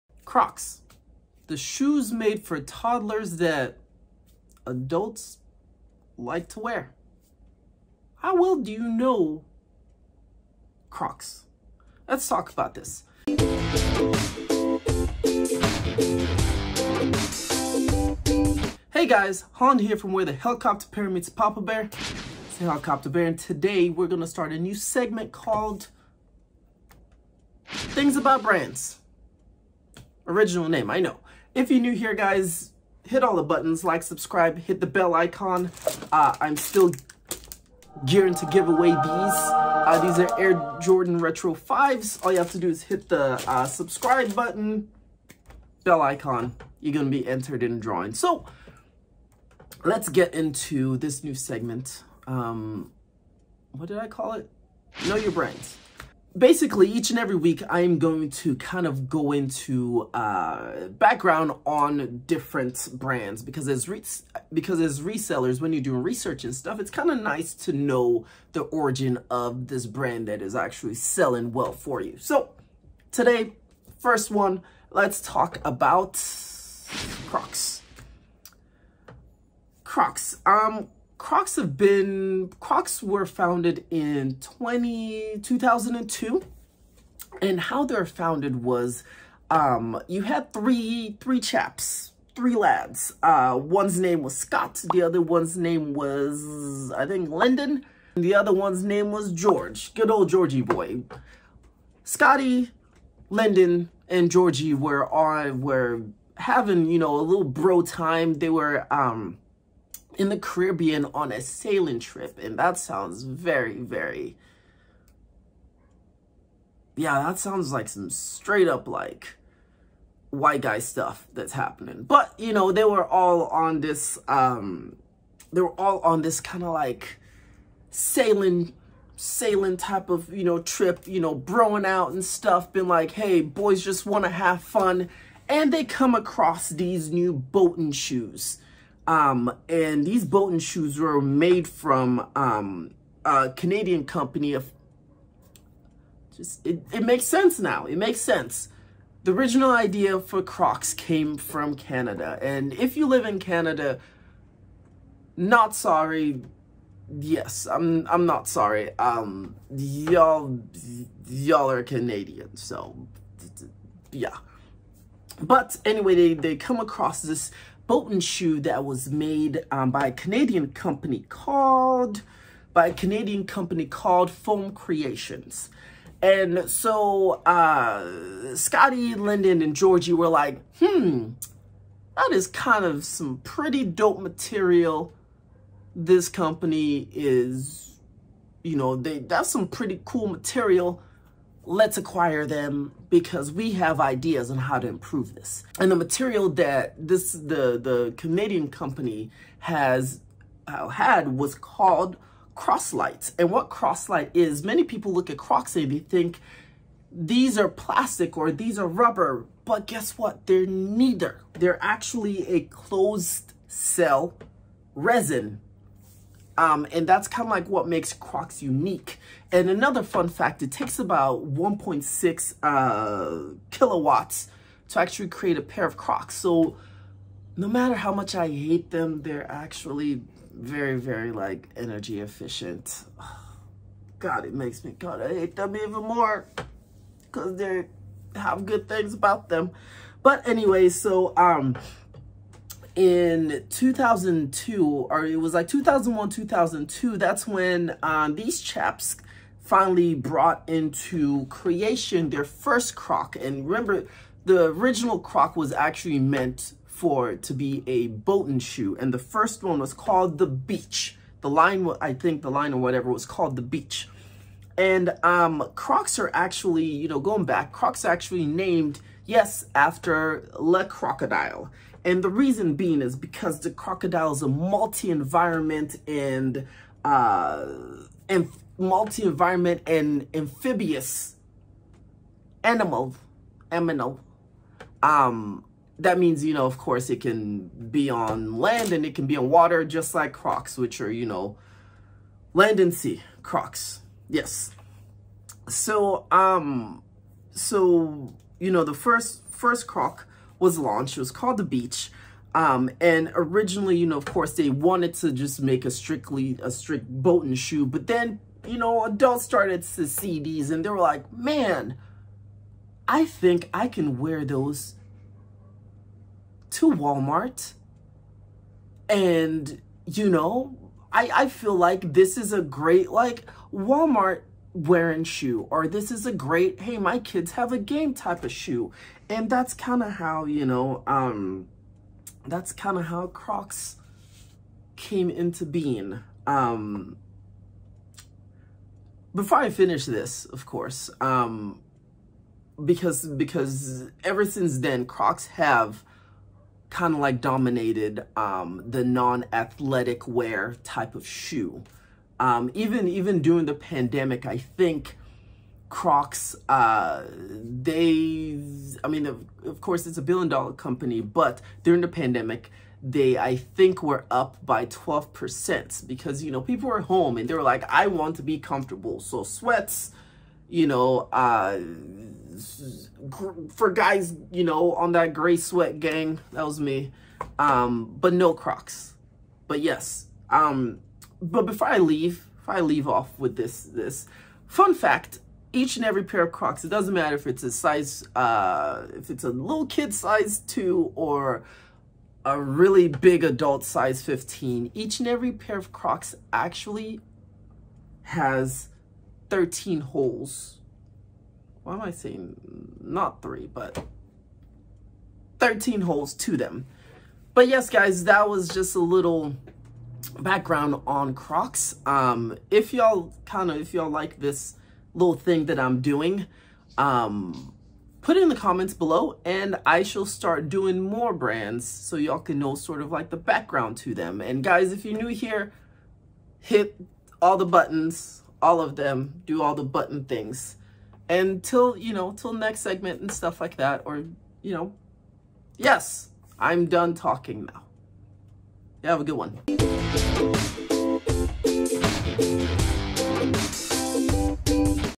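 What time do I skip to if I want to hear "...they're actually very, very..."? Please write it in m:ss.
3:49.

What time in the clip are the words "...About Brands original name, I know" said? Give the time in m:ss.
0:28.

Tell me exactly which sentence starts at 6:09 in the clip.
So sweats, you know, uh, for guys, you know, on that gray sweat gang, that was me.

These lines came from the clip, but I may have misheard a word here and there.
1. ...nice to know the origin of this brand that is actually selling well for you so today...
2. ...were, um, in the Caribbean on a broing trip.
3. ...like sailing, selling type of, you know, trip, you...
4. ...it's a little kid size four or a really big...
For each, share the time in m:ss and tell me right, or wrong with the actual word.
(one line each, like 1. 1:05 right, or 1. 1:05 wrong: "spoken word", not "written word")
1. 1:07 right
2. 1:48 wrong: "sailing", not "broing"
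3. 2:06 wrong: "sailing", not "selling"
4. 6:29 wrong: "two", not "four".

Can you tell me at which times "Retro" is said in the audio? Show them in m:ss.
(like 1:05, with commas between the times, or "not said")
0:41.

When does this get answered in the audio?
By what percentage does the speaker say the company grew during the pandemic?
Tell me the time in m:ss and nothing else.
6:04.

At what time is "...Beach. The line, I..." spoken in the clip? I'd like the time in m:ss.
4:20.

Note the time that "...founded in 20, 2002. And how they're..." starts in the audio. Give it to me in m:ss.
1:23.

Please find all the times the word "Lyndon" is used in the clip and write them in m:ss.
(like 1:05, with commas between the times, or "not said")
1:37, 1:43, 2:59.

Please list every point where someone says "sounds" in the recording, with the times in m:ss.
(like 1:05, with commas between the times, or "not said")
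1:52, 1:57.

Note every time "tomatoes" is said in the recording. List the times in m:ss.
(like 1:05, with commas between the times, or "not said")
not said.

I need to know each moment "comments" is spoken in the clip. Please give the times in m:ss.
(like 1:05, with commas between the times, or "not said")
6:58.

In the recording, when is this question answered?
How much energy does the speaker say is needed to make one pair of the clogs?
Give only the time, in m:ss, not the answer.
3:41.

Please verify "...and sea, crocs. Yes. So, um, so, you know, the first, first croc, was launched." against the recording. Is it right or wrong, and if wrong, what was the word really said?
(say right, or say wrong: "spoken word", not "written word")
right.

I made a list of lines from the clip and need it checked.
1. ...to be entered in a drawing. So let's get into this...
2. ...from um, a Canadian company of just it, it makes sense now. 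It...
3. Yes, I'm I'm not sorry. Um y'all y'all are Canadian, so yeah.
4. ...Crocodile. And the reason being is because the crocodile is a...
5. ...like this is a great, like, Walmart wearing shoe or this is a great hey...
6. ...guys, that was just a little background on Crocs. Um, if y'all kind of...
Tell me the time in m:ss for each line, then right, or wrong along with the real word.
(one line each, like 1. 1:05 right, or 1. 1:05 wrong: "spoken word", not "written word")
1. 0:47 right
2. 2:21 right
3. 2:37 right
4. 4:30 right
5. 5:21 right
6. 6:47 right.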